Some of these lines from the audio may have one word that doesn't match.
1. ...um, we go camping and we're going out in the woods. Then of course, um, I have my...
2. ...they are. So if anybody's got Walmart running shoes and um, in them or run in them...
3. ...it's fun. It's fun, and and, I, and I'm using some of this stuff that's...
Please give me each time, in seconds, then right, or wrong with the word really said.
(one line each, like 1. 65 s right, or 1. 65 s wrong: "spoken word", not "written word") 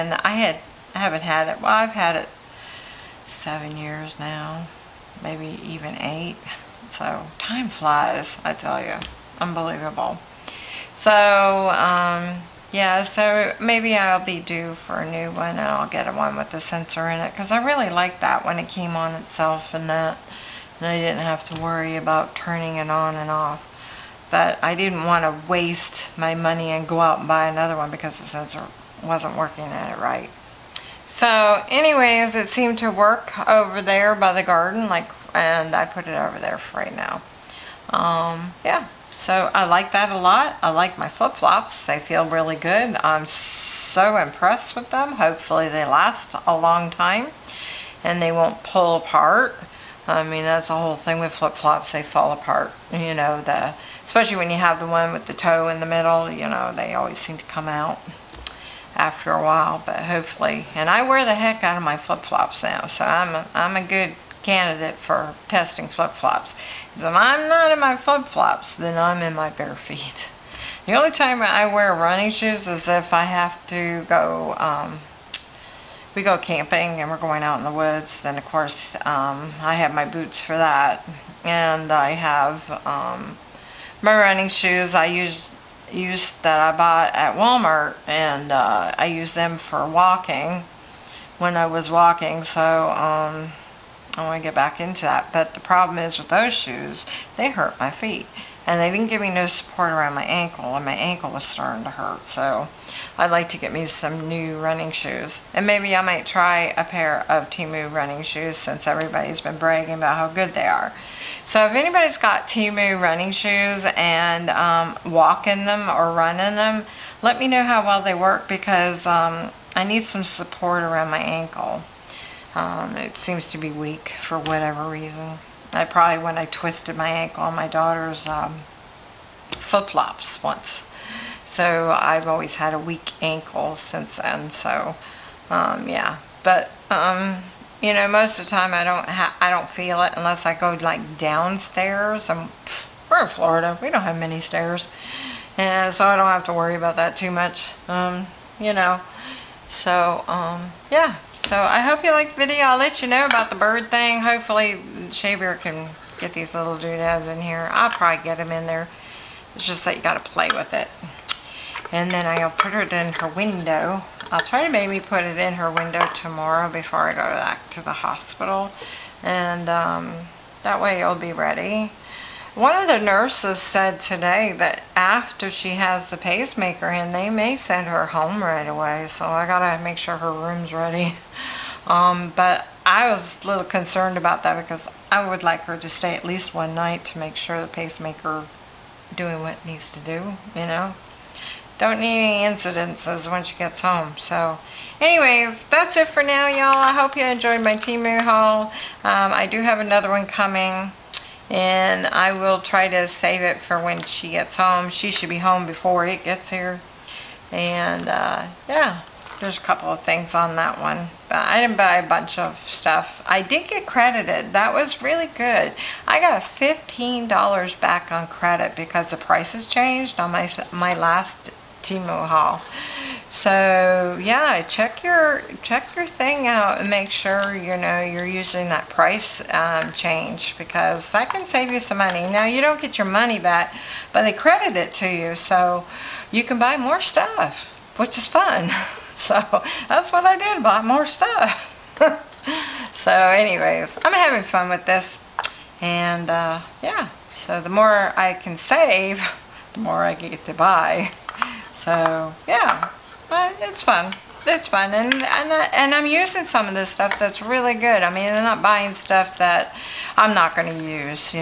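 1. 74 s right
2. 110 s wrong: "Temu", not "Walmart"
3. 253 s right.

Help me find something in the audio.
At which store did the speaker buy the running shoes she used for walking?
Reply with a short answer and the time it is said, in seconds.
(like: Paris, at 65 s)
Walmart, at 87 s.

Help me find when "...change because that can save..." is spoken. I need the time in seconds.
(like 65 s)
229 s.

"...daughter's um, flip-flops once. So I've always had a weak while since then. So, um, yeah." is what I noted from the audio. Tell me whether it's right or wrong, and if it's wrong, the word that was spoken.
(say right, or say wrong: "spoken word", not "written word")
wrong: "ankle", not "while".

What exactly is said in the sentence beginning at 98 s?
And they didn't give me no support around my ankle, and my ankle was starting to hurt.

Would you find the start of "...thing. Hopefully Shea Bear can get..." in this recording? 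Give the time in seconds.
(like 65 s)
153 s.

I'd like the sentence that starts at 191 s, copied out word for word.
Don't need any incidences when she gets home.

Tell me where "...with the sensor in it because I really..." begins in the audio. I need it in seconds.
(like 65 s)
16 s.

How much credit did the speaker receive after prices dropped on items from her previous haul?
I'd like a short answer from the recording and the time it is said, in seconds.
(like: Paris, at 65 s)
$15, at 216 s.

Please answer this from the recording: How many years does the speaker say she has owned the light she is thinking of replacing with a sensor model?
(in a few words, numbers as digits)
7.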